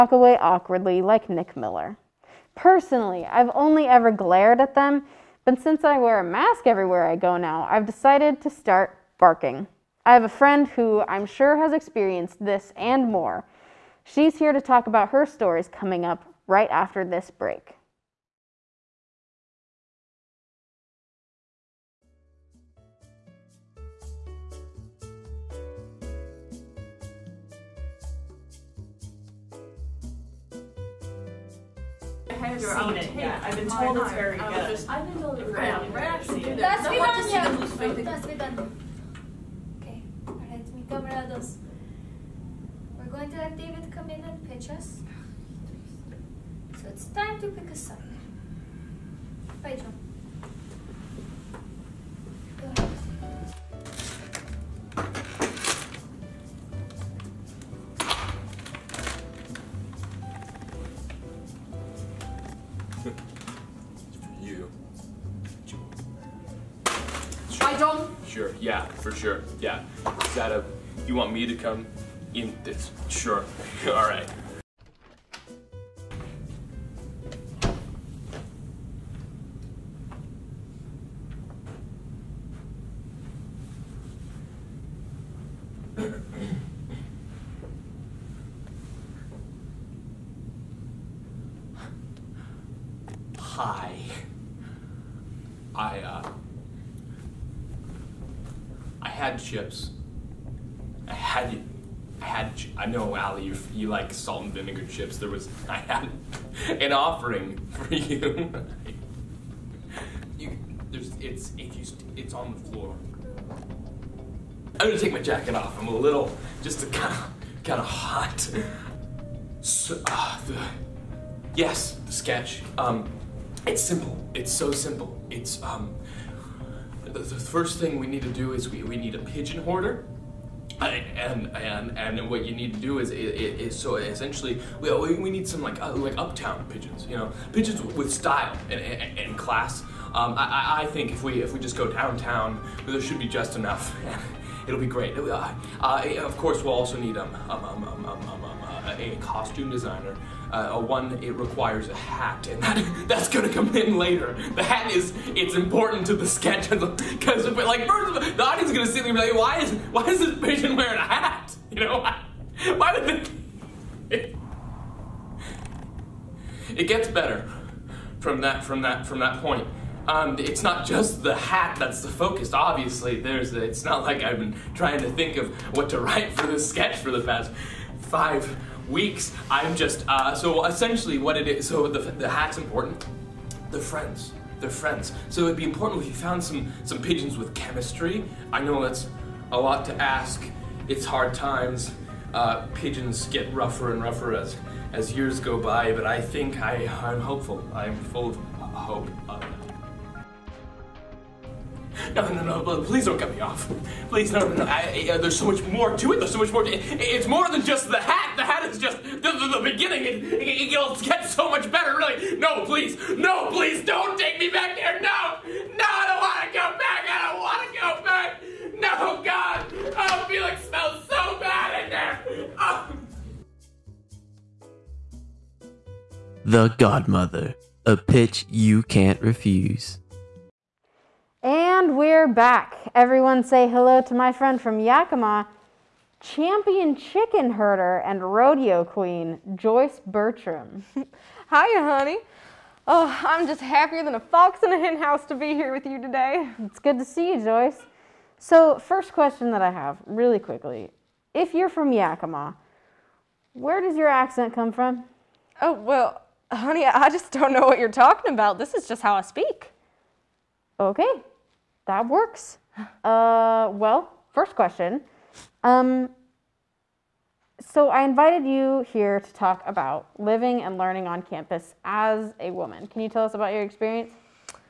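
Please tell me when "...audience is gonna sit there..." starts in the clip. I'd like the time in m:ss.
2:38.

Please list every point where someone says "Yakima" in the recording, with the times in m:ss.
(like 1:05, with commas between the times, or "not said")
3:54, 4:11.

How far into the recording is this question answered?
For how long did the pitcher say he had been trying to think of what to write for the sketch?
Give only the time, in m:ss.
2:57.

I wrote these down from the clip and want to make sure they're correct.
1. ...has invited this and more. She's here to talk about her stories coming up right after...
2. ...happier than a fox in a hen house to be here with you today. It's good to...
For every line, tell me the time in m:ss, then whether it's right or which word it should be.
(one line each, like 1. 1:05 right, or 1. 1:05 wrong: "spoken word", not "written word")
1. 0:11 wrong: "experienced", not "invited"
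2. 4:03 right.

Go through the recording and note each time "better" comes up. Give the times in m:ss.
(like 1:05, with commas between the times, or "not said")
2:47, 3:31.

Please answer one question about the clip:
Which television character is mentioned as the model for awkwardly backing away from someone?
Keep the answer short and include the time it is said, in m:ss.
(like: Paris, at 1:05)
Nick Miller, at 0:01.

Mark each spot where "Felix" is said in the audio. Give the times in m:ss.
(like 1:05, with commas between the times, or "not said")
3:40.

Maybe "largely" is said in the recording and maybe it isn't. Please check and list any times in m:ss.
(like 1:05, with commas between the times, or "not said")
not said.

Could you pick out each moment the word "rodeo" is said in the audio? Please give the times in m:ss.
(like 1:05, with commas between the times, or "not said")
3:58.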